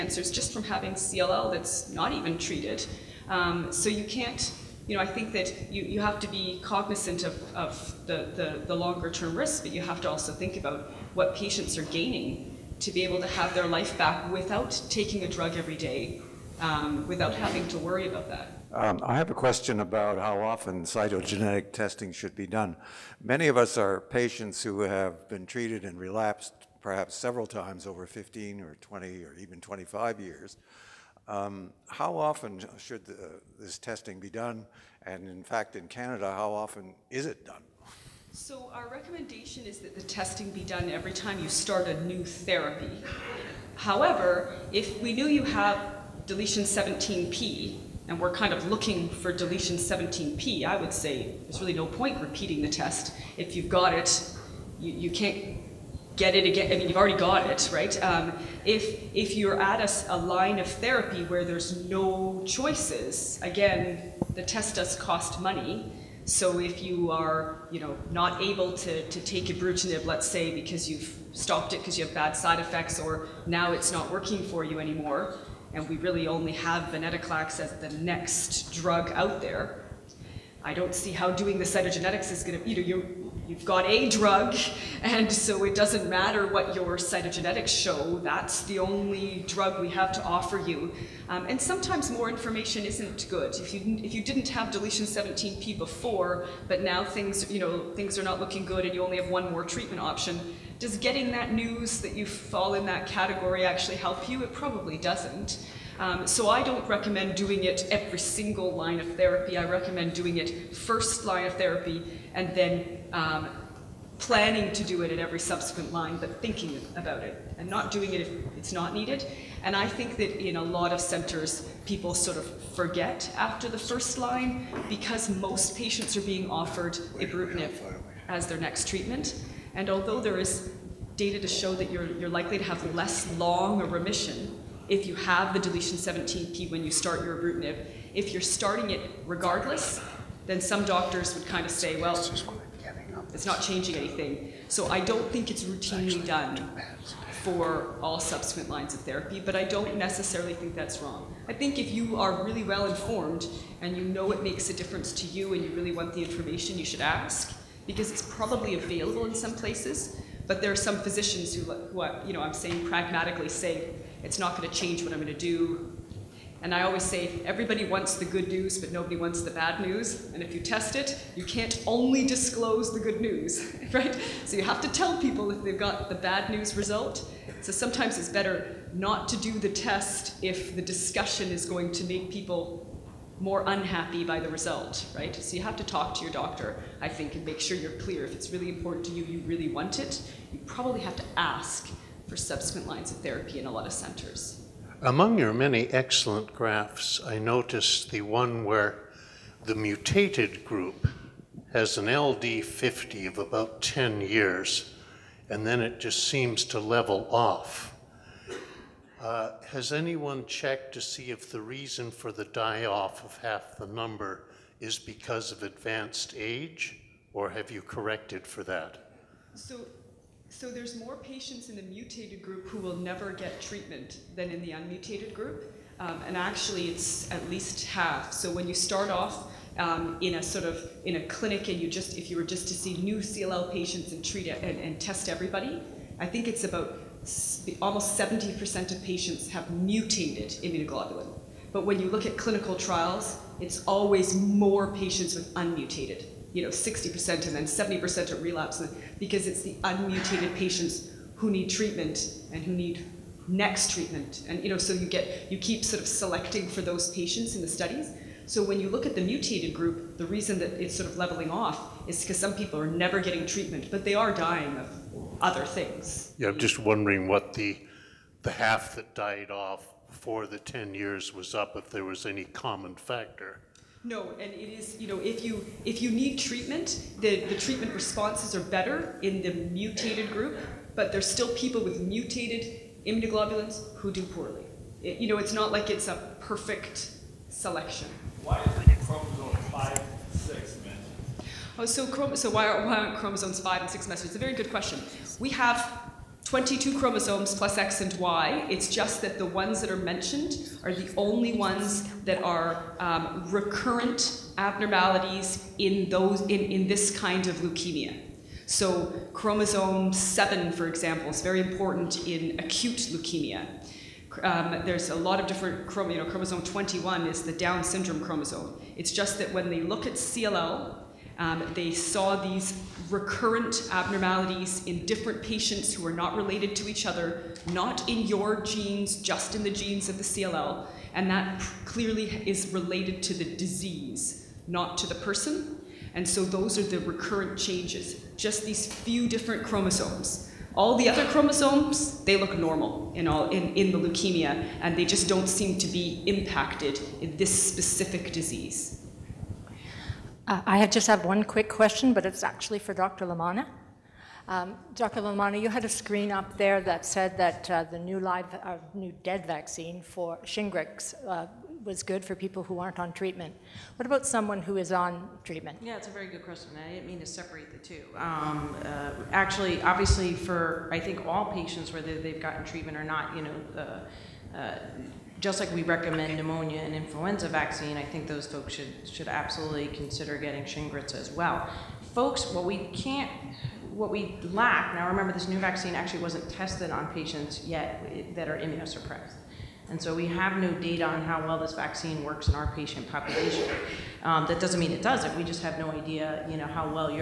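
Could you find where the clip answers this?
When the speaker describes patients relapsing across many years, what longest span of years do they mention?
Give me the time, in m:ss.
0:29.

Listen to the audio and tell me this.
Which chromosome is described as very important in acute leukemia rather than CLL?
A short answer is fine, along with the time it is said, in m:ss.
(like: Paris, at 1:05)
chromosome 7, at 5:09.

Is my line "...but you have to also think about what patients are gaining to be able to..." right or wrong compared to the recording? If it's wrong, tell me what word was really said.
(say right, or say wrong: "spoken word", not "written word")
right.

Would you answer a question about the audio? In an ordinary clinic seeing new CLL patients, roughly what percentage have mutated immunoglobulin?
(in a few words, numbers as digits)
70%.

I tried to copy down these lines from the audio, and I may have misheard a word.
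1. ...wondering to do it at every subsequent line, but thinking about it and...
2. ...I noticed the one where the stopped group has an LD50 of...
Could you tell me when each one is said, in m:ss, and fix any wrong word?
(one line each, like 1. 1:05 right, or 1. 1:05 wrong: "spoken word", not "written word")
1. 1:54 wrong: "planning", not "wondering"
2. 3:17 wrong: "mutated", not "stopped".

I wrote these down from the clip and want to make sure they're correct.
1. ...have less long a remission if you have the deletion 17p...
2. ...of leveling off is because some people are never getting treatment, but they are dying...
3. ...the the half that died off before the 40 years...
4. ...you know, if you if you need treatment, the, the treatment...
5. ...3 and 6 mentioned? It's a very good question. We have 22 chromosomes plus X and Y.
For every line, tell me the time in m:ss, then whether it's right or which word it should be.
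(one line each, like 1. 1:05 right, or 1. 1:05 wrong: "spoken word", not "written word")
1. 2:12 right
2. 4:21 right
3. 4:27 wrong: "10", not "40"
4. 4:34 right
5. 4:53 wrong: "5", not "3".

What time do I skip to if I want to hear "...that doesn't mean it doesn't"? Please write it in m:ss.
6:34.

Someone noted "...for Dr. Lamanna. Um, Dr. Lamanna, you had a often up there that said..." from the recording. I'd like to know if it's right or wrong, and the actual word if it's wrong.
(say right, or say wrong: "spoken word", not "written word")
wrong: "screen", not "often".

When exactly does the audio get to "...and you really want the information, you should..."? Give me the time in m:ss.
2:35.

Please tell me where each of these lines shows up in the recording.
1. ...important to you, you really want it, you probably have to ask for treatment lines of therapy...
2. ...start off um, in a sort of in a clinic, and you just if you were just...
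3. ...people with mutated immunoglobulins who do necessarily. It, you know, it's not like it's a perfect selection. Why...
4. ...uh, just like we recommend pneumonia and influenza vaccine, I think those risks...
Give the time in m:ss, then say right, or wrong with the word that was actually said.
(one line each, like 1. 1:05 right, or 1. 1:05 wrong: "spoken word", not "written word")
1. 3:08 wrong: "subsequent", not "treatment"
2. 3:48 right
3. 4:41 wrong: "poorly", not "necessarily"
4. 6:14 wrong: "folks", not "risks".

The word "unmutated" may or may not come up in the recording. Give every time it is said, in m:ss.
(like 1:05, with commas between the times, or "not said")
3:44, 4:05, 4:09.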